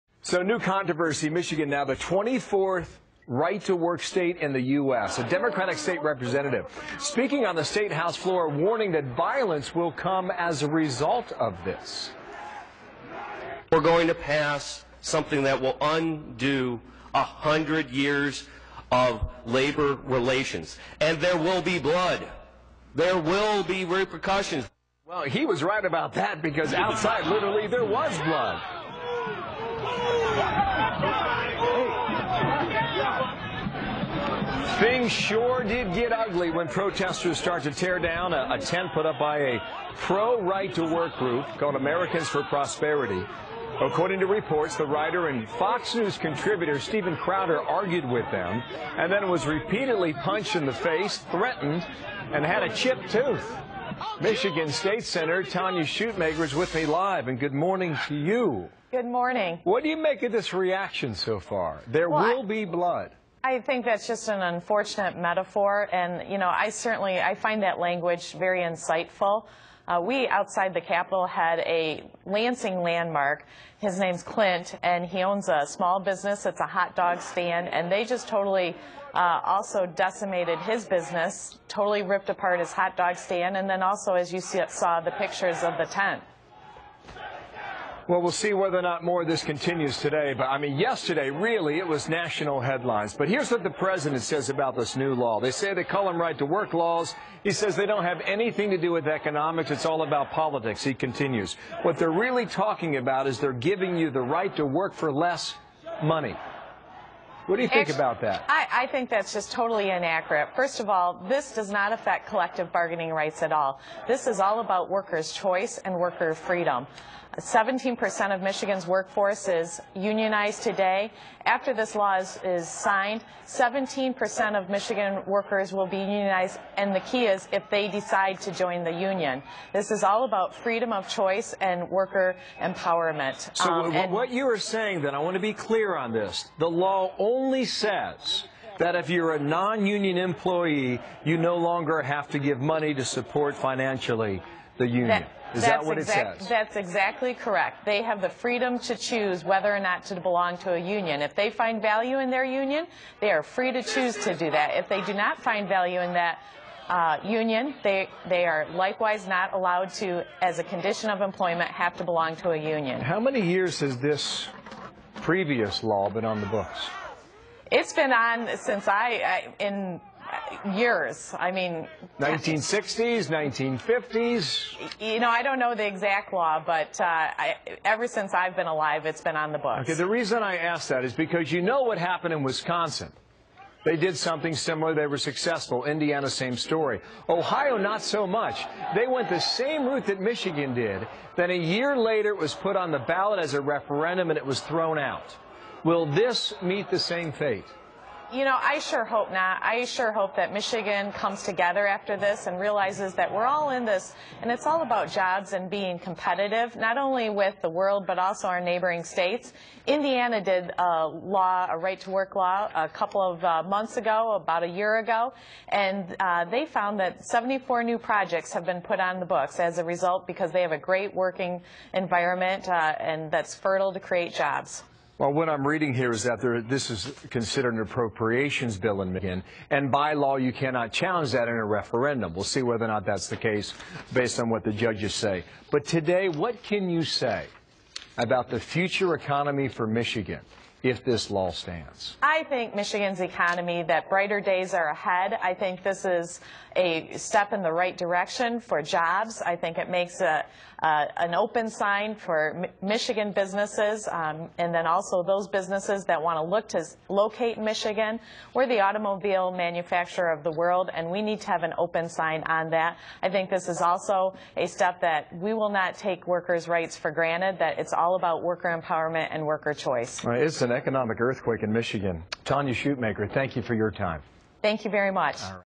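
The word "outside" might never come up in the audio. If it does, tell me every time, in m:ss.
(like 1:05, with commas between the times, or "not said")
0:26, 1:10.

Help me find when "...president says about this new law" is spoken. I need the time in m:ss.
1:33.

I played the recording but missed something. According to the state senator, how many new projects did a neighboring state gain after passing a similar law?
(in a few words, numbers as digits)
74.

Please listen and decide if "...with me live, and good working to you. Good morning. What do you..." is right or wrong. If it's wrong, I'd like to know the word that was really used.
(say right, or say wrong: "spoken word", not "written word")
wrong: "morning", not "working".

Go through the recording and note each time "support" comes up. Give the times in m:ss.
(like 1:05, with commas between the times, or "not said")
2:23.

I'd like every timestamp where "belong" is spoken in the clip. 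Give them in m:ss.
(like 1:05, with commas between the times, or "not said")
2:30, 2:42.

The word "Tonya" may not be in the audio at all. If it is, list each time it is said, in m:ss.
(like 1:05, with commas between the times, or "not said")
0:55, 4:32.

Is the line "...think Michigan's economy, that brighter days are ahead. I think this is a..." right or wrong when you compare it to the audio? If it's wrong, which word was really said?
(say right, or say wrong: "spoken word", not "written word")
right.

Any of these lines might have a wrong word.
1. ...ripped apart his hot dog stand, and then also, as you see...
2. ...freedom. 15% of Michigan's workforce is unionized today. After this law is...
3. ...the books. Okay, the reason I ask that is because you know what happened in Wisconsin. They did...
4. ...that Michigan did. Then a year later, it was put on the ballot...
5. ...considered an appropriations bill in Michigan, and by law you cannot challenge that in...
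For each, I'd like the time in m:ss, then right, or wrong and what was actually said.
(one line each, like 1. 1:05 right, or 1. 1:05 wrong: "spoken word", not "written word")
1. 1:22 right
2. 1:56 wrong: "17", not "15"
3. 2:59 right
4. 3:10 right
5. 3:47 right.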